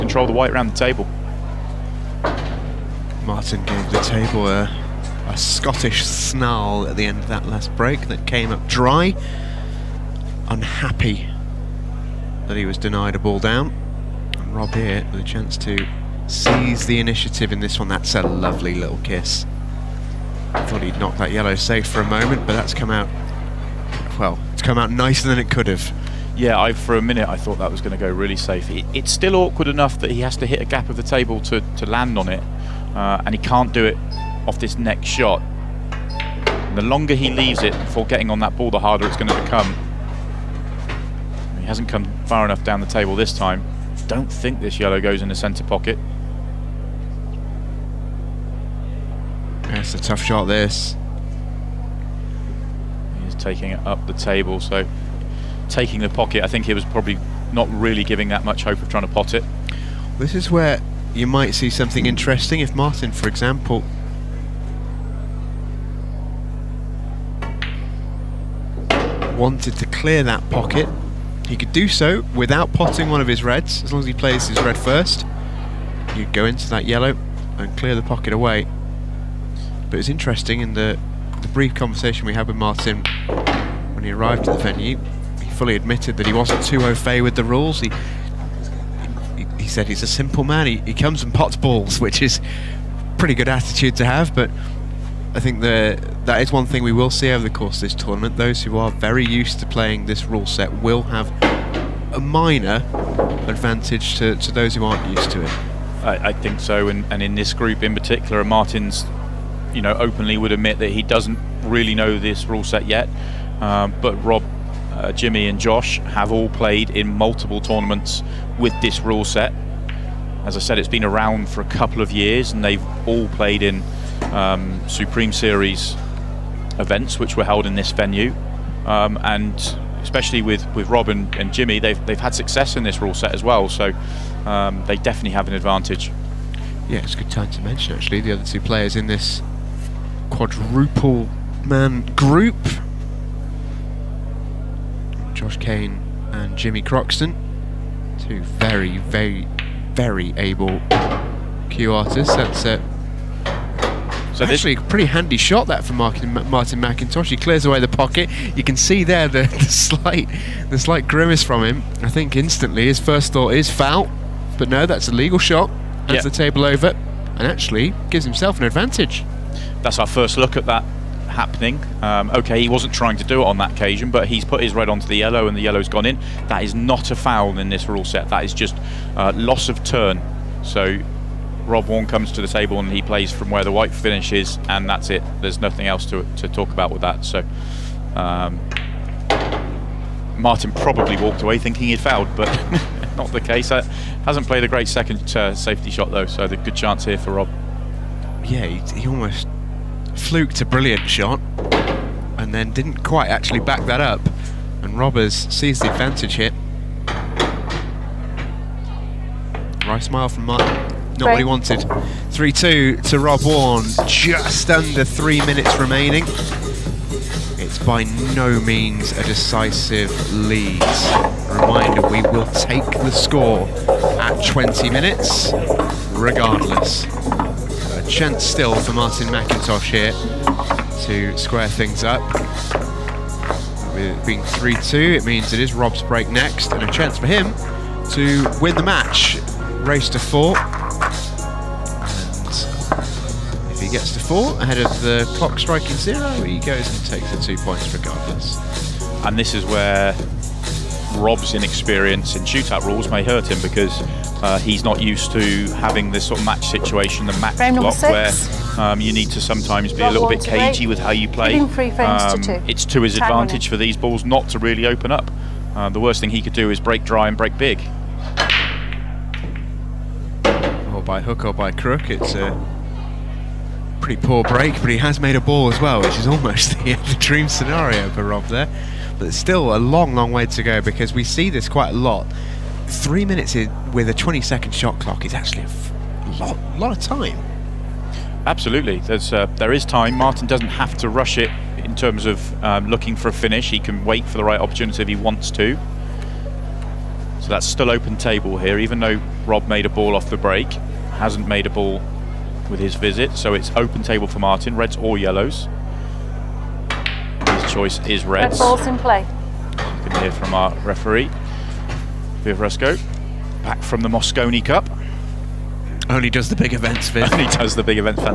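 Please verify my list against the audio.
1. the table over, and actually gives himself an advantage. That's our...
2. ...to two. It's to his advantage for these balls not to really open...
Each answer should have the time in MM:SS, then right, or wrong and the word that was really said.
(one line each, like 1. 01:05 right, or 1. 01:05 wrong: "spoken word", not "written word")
1. 02:46 right
2. 04:22 right.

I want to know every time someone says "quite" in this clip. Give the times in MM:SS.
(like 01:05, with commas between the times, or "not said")
03:23, 04:41.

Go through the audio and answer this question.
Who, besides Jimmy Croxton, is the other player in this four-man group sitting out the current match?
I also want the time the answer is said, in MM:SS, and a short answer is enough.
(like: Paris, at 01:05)
Josh Kane, at 02:25.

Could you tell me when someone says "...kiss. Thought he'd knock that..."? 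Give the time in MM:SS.
00:18.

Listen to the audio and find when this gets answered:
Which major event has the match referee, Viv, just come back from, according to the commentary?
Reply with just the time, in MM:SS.
05:14.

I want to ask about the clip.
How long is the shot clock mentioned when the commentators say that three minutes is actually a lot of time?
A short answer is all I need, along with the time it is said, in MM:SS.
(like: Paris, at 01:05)
20 seconds, at 04:44.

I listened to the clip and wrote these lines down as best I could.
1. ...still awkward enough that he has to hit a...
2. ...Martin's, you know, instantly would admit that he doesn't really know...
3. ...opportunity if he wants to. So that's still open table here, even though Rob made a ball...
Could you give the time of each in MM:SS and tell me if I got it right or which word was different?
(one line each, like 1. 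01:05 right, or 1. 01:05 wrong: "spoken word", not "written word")
1. 00:29 right
2. 01:48 wrong: "openly", not "instantly"
3. 04:54 right.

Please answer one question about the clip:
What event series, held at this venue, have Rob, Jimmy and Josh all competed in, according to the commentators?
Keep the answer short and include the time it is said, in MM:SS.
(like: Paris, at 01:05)
Supreme Series, at 02:04.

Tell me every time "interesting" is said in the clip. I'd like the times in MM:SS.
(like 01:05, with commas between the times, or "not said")
01:02, 01:20.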